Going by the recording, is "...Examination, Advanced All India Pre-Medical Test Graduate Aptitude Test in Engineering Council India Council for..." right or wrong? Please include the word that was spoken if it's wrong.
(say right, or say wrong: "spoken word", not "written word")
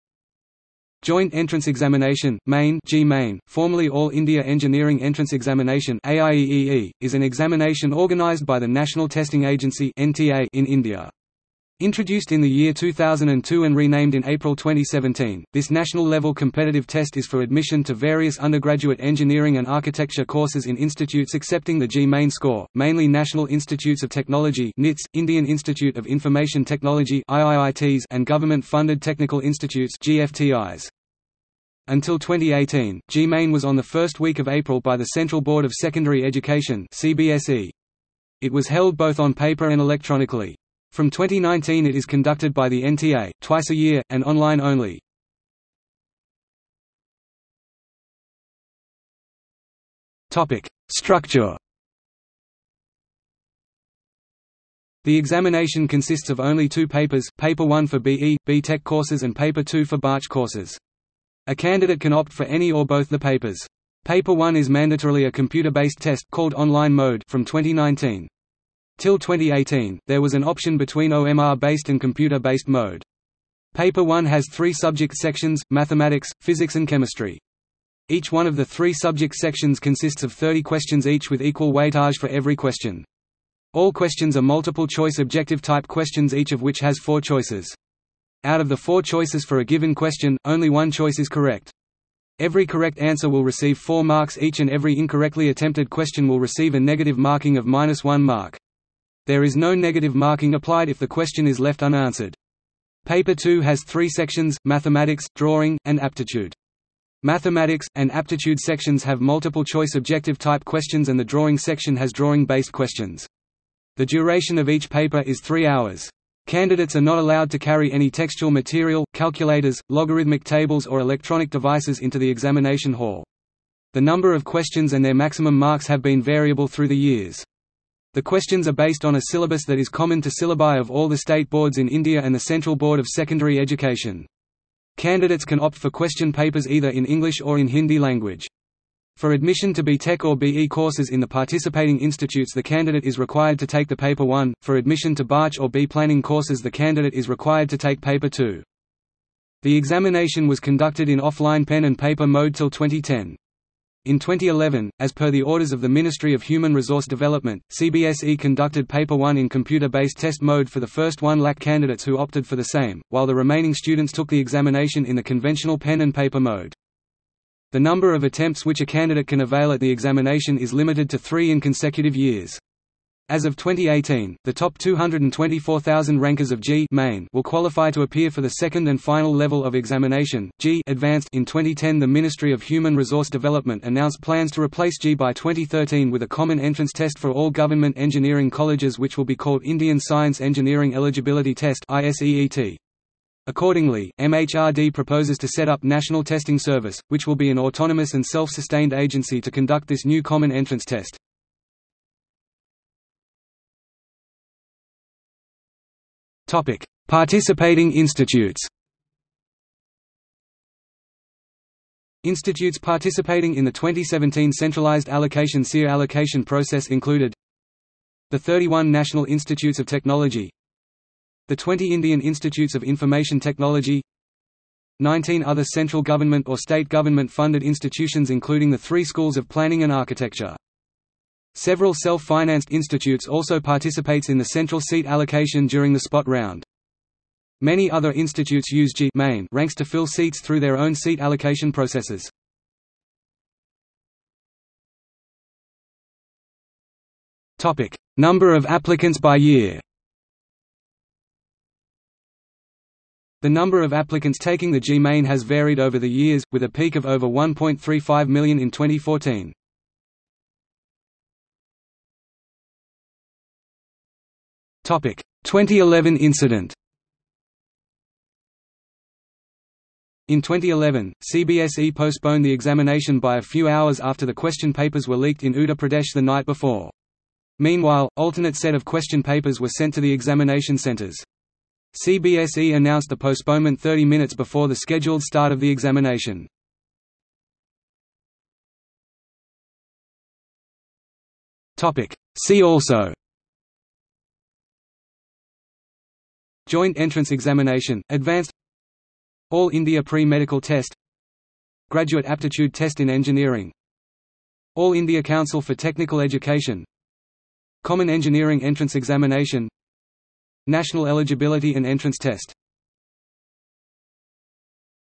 wrong: "All", not "Council".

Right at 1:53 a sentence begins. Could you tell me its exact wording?
The duration of each paper is three hours.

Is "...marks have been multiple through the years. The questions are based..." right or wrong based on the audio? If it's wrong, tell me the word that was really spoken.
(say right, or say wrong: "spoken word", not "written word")
wrong: "variable", not "multiple".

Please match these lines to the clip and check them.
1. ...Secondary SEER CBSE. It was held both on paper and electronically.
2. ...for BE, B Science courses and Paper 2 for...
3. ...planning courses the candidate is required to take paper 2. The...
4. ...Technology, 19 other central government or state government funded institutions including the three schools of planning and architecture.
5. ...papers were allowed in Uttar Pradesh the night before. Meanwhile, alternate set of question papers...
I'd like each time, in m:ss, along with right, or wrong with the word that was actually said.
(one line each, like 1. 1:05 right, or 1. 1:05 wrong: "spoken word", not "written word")
1. 0:35 wrong: "Education", not "SEER"
2. 0:57 wrong: "Tech", not "Science"
3. 2:25 right
4. 3:43 right
5. 4:34 wrong: "leaked", not "allowed".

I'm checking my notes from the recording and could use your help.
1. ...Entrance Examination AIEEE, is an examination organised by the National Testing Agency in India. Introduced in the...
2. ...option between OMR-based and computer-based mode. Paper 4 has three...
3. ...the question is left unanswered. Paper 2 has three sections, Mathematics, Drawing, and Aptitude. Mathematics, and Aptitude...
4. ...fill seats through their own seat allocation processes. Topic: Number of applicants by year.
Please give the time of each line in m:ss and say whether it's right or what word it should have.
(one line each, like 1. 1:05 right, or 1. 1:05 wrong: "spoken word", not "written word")
1. 0:05 right
2. 1:10 wrong: "1", not "4"
3. 1:40 right
4. 3:59 right.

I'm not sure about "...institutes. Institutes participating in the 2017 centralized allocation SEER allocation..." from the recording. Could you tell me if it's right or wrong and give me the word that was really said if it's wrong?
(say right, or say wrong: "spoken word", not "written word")
right.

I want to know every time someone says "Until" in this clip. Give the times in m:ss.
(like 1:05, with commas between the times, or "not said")
0:31.